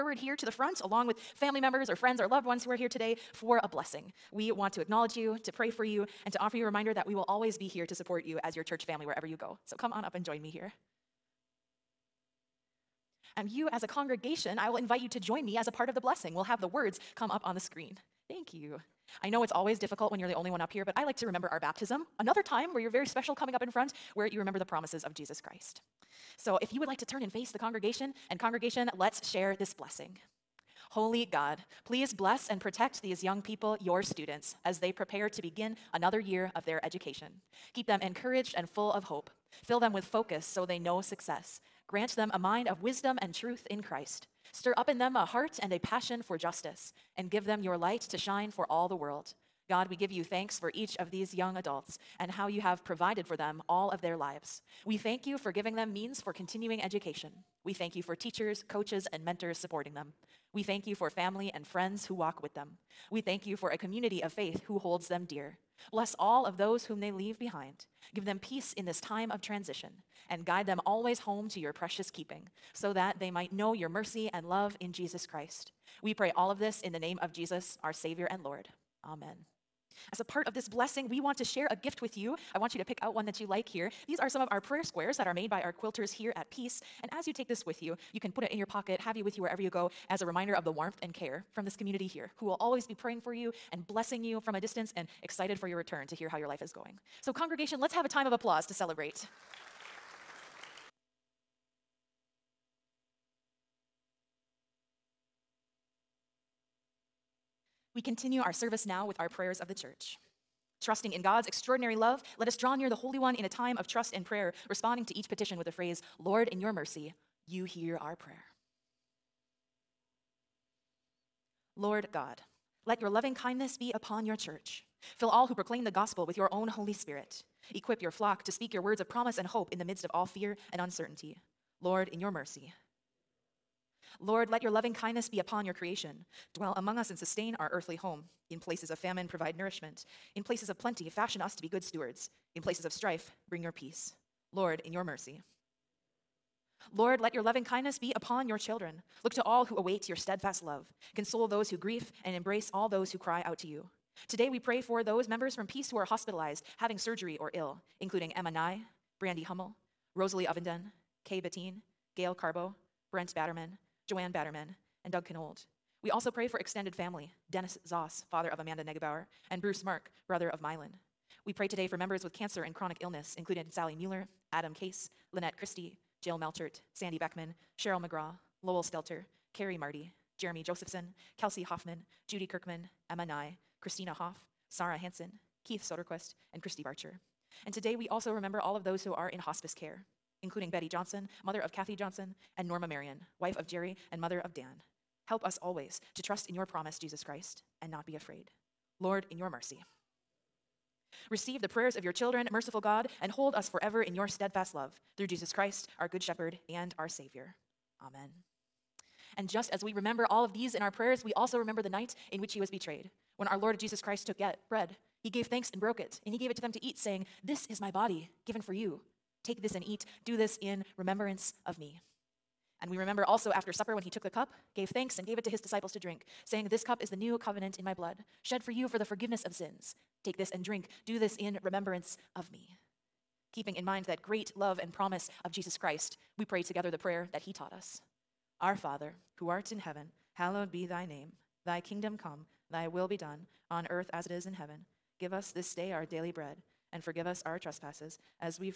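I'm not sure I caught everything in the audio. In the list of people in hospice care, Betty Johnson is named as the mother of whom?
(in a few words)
Kathy Johnson.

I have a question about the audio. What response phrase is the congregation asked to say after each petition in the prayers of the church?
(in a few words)
Lord, in your mercy, you hear our prayer.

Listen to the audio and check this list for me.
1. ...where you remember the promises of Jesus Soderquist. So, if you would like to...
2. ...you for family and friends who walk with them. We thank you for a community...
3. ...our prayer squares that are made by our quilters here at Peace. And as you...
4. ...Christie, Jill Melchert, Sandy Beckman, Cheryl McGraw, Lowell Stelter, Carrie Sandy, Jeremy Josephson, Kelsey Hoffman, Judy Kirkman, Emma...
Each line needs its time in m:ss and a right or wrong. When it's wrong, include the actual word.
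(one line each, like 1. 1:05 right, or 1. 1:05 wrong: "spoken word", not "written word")
1. 0:24 wrong: "Christ", not "Soderquist"
2. 1:00 right
3. 1:24 right
4. 2:55 wrong: "Marty", not "Sandy".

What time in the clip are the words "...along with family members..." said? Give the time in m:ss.
0:00.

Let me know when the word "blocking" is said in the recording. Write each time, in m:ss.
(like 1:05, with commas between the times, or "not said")
not said.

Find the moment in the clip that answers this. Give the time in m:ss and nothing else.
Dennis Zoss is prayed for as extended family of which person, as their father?
2:48.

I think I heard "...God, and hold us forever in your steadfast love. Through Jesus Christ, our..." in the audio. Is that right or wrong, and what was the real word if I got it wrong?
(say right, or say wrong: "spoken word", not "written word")
right.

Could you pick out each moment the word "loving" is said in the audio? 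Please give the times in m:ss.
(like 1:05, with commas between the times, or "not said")
2:03, 2:14, 2:27.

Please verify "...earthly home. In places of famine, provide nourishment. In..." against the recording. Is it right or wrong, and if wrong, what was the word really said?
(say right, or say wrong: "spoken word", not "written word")
right.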